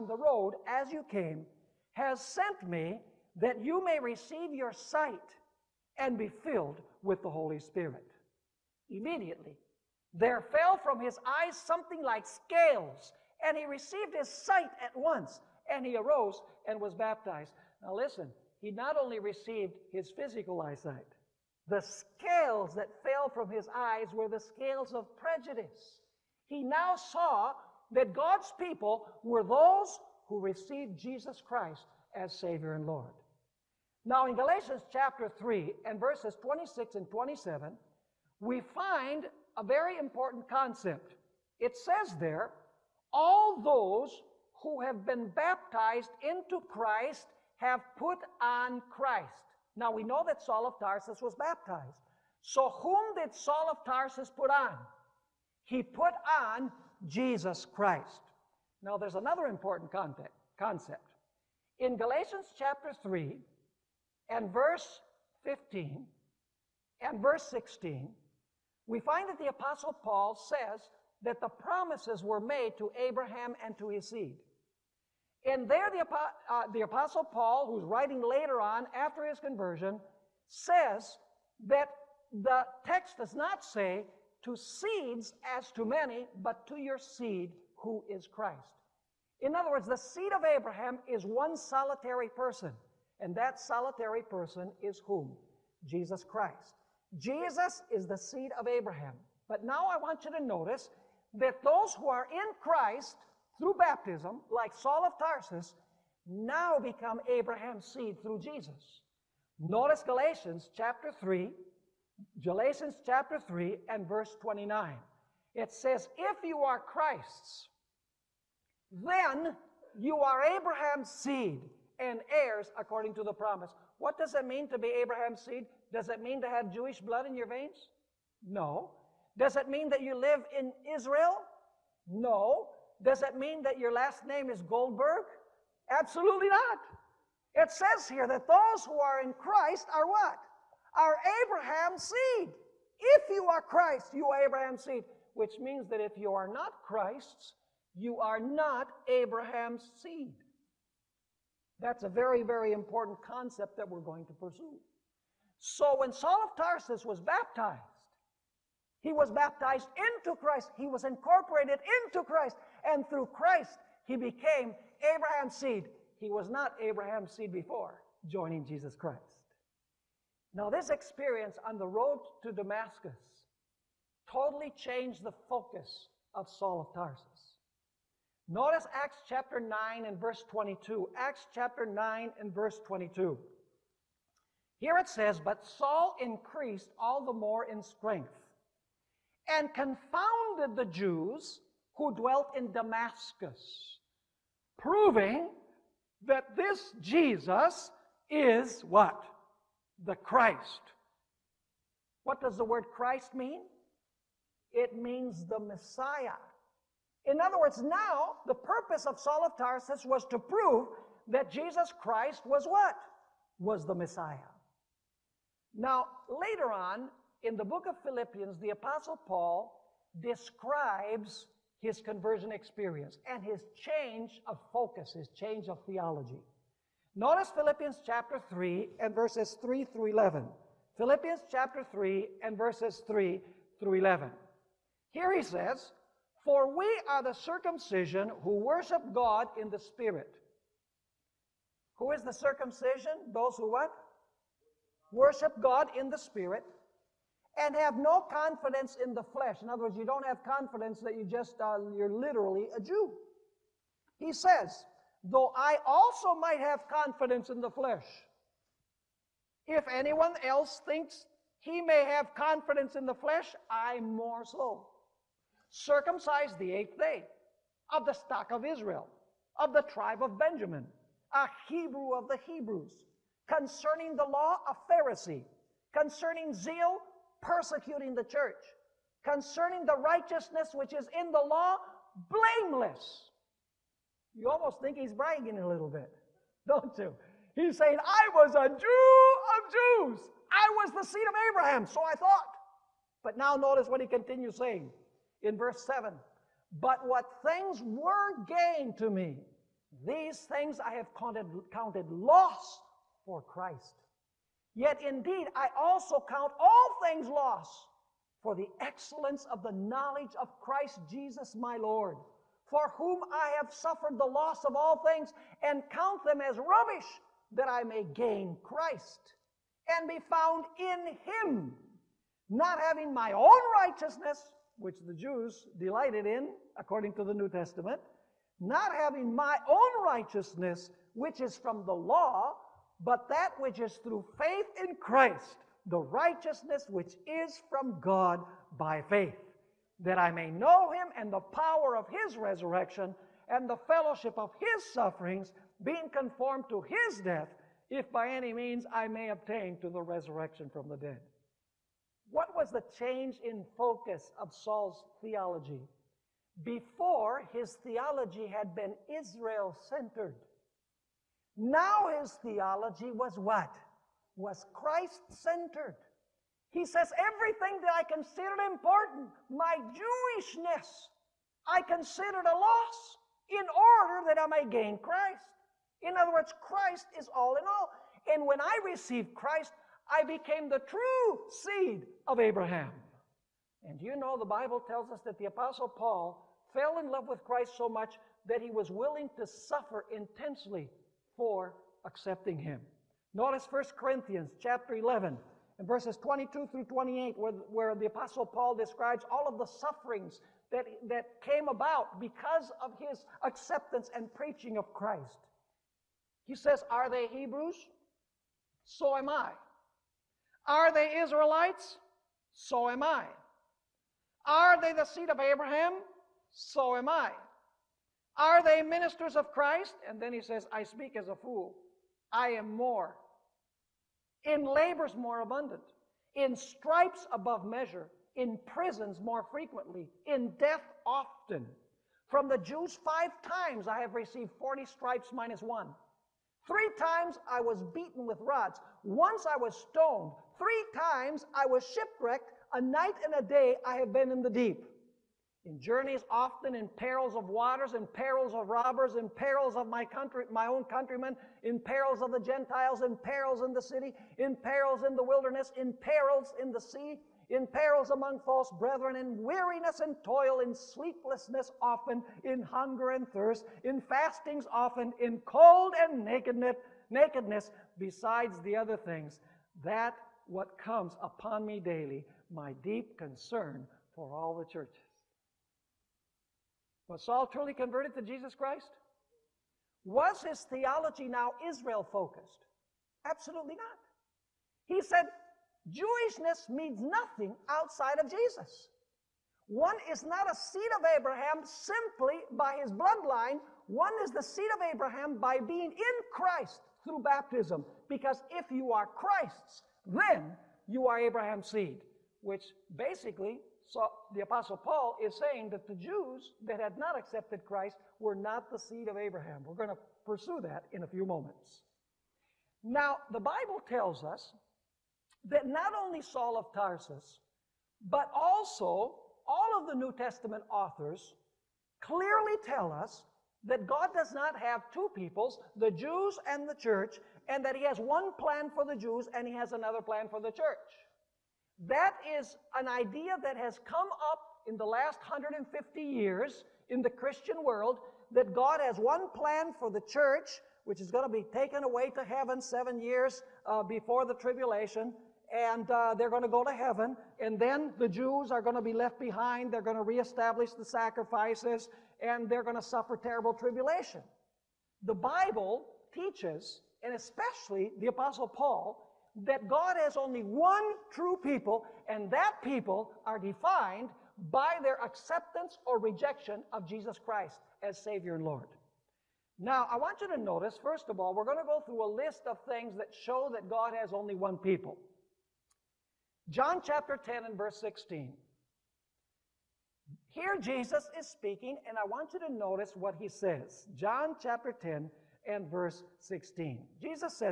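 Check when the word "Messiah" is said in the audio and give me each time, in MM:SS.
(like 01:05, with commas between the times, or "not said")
03:25, 03:33.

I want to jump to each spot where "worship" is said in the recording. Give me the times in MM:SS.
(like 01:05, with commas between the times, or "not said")
03:58, 04:05.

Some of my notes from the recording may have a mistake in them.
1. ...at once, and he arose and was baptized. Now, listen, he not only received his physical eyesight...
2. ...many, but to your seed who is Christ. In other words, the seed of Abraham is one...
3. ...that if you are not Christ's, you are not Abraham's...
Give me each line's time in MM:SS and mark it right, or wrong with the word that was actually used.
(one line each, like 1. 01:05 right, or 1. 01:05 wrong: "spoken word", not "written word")
1. 00:14 right
2. 01:25 right
3. 02:25 right.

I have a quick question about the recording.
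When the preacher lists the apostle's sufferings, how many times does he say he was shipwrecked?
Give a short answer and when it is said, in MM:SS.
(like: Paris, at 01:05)
3, at 07:20.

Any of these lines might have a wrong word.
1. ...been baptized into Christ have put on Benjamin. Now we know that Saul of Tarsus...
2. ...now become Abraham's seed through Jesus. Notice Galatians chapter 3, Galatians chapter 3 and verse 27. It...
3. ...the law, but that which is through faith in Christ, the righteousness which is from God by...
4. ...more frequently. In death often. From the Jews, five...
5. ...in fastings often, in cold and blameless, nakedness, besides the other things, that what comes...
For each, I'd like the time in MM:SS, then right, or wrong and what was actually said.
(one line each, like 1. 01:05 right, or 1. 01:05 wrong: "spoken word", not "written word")
1. 00:45 wrong: "Christ", not "Benjamin"
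2. 01:46 wrong: "29", not "27"
3. 05:31 right
4. 07:09 right
5. 07:43 wrong: "nakedness", not "blameless".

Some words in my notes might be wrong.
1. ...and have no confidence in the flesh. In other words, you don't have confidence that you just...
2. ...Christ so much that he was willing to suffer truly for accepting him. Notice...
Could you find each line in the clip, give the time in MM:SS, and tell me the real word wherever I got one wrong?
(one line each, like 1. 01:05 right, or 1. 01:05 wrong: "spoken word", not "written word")
1. 04:07 right
2. 06:27 wrong: "intensely", not "truly".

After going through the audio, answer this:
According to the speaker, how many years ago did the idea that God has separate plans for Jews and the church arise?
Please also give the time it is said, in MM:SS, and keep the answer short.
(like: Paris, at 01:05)
150 years, at 08:55.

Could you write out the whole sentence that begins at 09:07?
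And then the Jews are going to be left behind.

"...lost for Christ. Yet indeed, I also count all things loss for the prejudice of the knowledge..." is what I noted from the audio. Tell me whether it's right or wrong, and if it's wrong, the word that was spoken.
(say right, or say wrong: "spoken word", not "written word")
wrong: "excellence", not "prejudice".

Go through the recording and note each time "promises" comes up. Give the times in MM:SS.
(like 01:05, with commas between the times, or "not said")
01:11, 02:03.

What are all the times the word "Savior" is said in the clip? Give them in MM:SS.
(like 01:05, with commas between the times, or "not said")
00:32, 09:28.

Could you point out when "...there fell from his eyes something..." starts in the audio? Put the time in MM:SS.
00:10.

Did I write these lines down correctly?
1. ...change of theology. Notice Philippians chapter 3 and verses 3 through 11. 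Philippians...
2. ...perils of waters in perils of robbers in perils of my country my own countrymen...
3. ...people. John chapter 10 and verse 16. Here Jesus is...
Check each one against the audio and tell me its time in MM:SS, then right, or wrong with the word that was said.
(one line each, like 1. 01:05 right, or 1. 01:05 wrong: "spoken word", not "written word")
1. 03:45 right
2. 07:26 right
3. 09:34 right.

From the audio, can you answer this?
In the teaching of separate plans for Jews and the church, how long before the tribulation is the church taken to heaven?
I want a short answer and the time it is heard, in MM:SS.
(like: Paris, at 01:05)
7 years, at 09:02.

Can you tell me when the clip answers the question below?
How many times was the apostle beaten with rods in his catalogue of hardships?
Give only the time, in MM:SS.
07:16.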